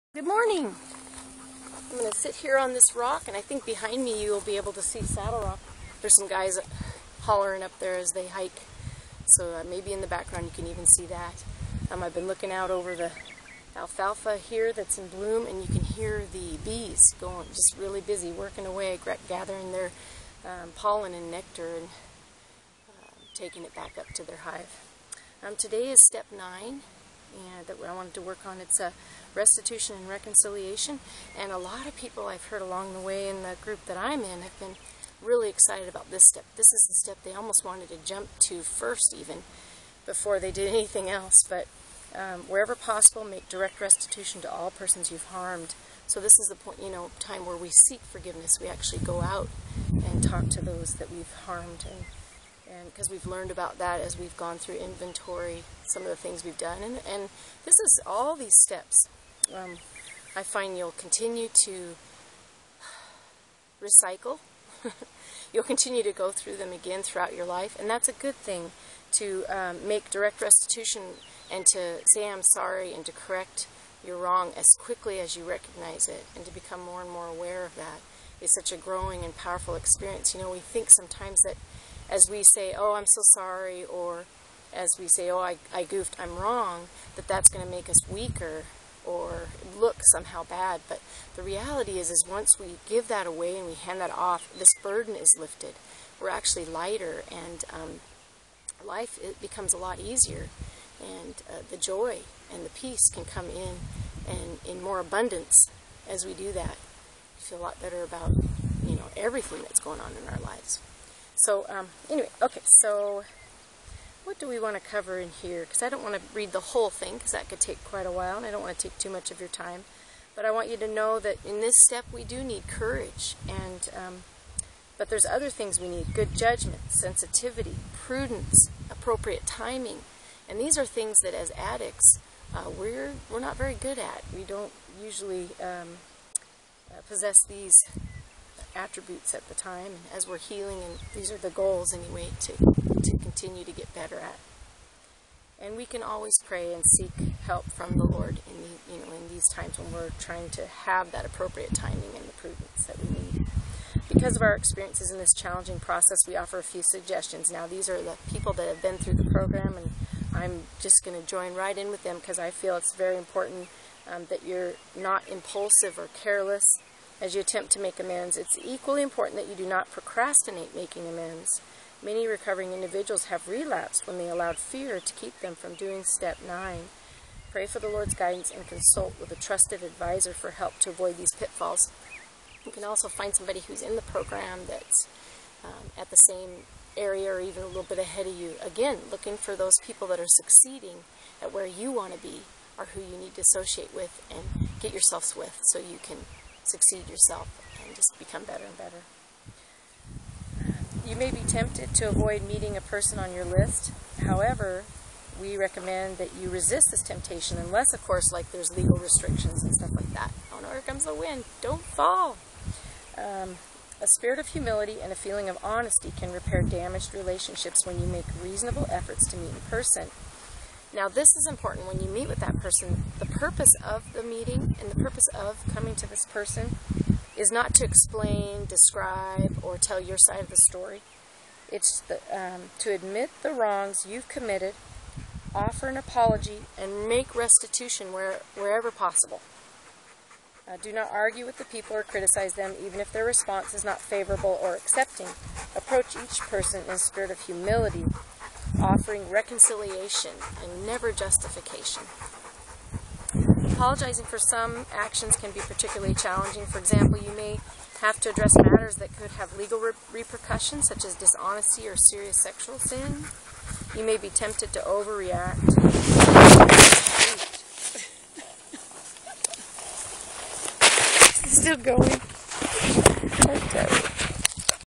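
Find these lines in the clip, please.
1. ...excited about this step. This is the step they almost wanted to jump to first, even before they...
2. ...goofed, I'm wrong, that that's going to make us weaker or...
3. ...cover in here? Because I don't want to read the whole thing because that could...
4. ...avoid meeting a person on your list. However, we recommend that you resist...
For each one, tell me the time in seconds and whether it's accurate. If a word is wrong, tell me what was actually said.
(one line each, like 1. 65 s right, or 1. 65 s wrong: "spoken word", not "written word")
1. 35 s right
2. 85 s right
3. 114 s right
4. 202 s right.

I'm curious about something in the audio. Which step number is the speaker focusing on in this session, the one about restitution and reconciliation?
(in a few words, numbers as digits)
9.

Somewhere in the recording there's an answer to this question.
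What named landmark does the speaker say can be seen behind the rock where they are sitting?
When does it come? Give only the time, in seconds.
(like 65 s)
5 s.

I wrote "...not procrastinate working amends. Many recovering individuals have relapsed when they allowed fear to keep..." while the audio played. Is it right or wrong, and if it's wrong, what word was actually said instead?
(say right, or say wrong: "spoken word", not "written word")
wrong: "making", not "working".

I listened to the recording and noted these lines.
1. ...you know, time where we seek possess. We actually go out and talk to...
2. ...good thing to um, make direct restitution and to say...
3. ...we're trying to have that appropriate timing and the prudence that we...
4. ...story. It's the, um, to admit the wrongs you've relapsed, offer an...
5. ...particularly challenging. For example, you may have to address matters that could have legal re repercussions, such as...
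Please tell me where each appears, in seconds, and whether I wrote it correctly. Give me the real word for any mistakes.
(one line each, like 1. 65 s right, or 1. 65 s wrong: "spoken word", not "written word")
1. 46 s wrong: "forgiveness", not "possess"
2. 68 s right
3. 149 s right
4. 230 s wrong: "committed", not "relapsed"
5. 255 s right.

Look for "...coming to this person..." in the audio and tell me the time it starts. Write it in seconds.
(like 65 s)
225 s.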